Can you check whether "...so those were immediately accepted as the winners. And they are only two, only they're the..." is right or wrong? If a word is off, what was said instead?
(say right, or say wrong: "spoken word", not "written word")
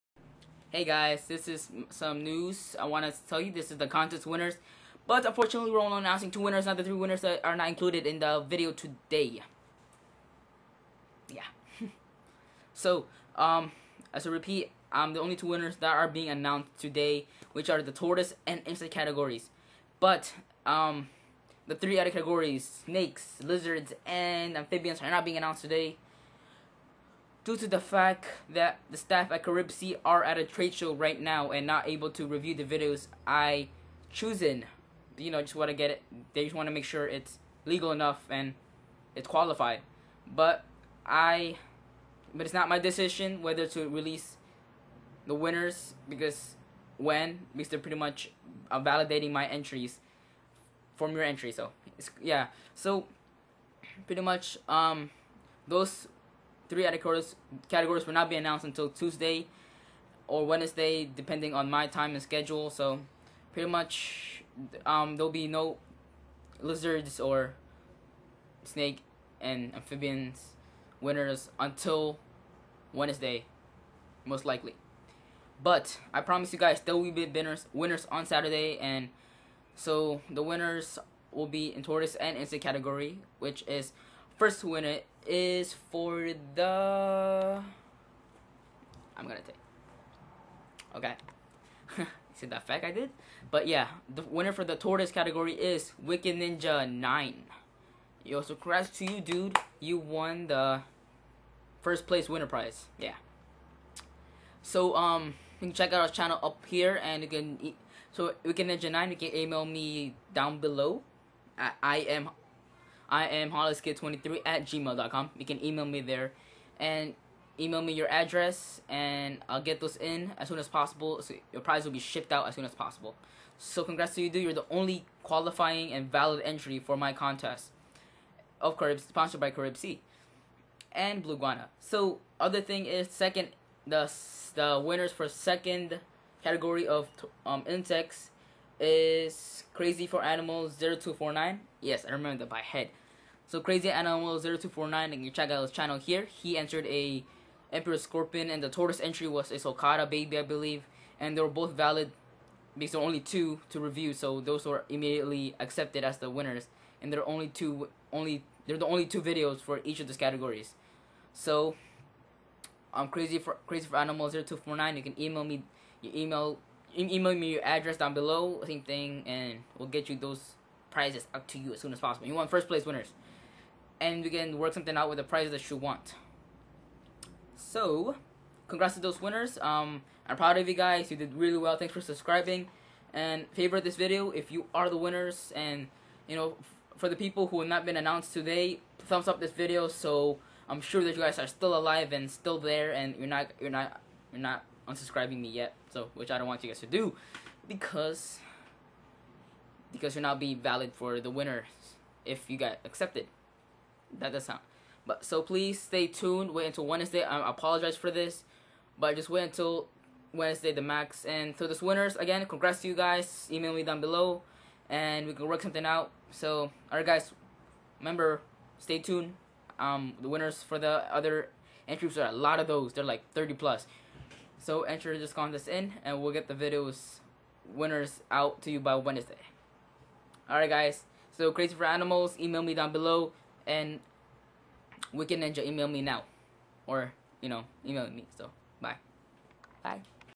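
right.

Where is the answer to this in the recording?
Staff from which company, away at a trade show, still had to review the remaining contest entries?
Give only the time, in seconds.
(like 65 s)
29 s.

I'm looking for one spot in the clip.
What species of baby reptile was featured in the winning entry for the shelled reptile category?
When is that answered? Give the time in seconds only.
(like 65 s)
149 s.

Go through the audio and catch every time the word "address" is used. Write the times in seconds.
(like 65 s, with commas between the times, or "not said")
118 s, 167 s.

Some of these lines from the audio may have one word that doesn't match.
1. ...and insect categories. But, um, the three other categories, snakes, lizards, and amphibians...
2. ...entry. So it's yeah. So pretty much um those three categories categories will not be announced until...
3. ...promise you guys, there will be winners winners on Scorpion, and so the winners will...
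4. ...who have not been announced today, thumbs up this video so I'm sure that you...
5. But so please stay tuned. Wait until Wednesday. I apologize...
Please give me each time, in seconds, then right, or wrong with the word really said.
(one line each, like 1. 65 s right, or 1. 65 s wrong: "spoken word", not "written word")
1. 18 s right
2. 51 s right
3. 76 s wrong: "Saturday", not "Scorpion"
4. 187 s right
5. 205 s right.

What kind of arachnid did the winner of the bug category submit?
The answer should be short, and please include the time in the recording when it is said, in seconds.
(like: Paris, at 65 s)
Emperor Scorpion, at 147 s.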